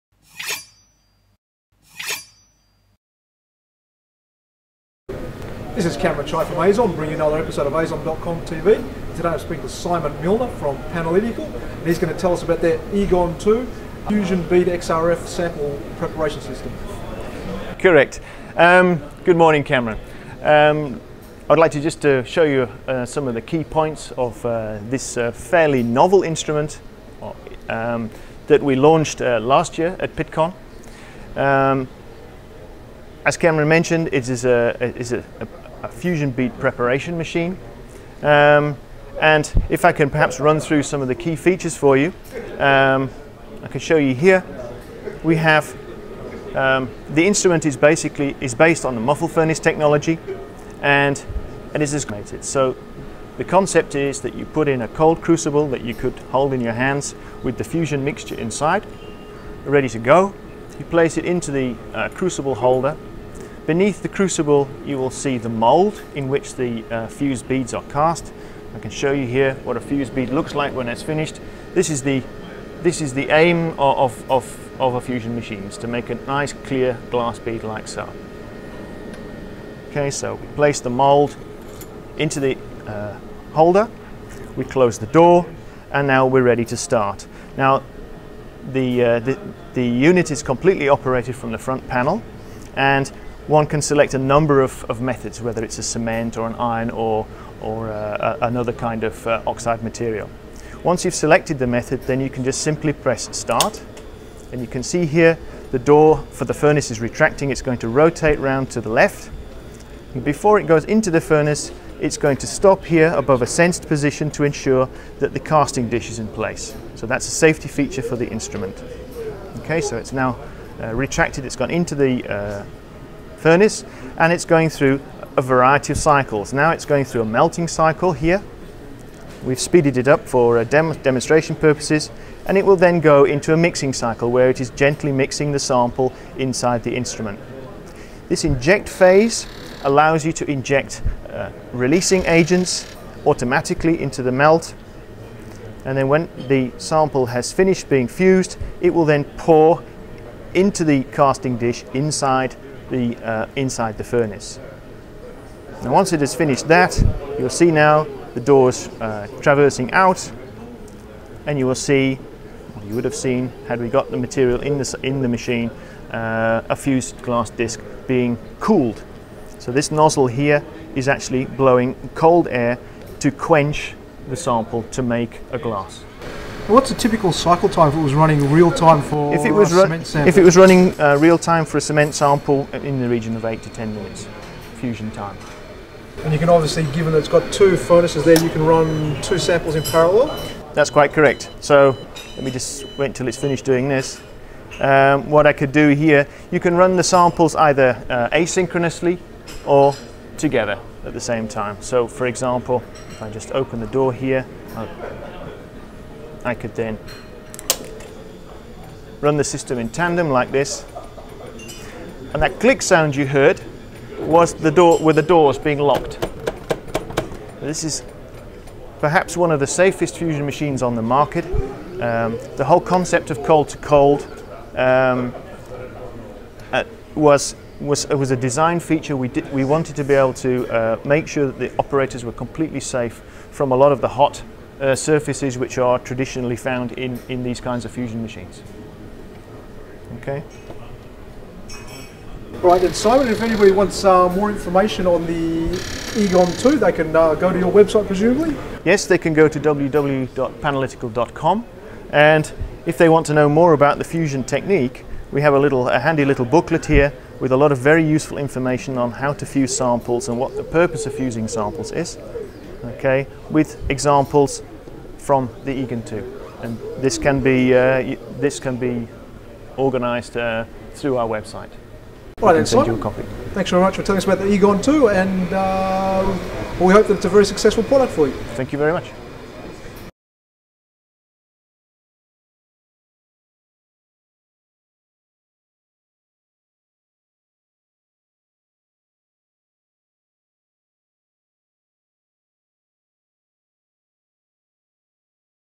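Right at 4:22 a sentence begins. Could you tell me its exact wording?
Okay, with examples from the Eagon 2.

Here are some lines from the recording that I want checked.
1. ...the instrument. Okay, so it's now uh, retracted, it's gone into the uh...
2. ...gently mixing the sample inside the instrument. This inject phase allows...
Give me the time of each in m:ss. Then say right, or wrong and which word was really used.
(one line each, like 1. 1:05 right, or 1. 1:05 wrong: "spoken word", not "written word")
1. 1:58 right
2. 2:14 right.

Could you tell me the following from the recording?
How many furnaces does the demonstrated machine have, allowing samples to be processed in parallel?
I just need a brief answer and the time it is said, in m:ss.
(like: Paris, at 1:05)
2, at 3:07.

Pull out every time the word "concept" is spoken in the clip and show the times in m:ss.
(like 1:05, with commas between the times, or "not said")
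0:53, 3:42.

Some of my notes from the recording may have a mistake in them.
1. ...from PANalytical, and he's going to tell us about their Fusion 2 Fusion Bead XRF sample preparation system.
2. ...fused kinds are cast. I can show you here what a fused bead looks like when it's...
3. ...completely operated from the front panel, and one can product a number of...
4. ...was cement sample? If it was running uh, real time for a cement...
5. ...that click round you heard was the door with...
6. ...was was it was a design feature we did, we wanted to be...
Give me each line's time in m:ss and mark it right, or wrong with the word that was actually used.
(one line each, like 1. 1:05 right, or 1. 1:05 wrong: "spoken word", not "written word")
1. 0:10 wrong: "Eagon", not "Fusion"
2. 1:07 wrong: "beads", not "kinds"
3. 1:30 wrong: "select", not "product"
4. 2:59 right
5. 3:32 wrong: "sound", not "round"
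6. 3:47 right.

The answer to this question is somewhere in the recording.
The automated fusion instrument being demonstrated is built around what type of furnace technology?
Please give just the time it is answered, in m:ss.
0:49.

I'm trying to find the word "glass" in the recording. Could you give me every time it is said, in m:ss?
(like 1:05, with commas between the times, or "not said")
1:17, 2:47, 2:55.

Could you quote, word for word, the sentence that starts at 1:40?
Once you've selected the method, then you can just simply press start.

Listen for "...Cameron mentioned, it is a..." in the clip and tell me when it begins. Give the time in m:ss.
0:33.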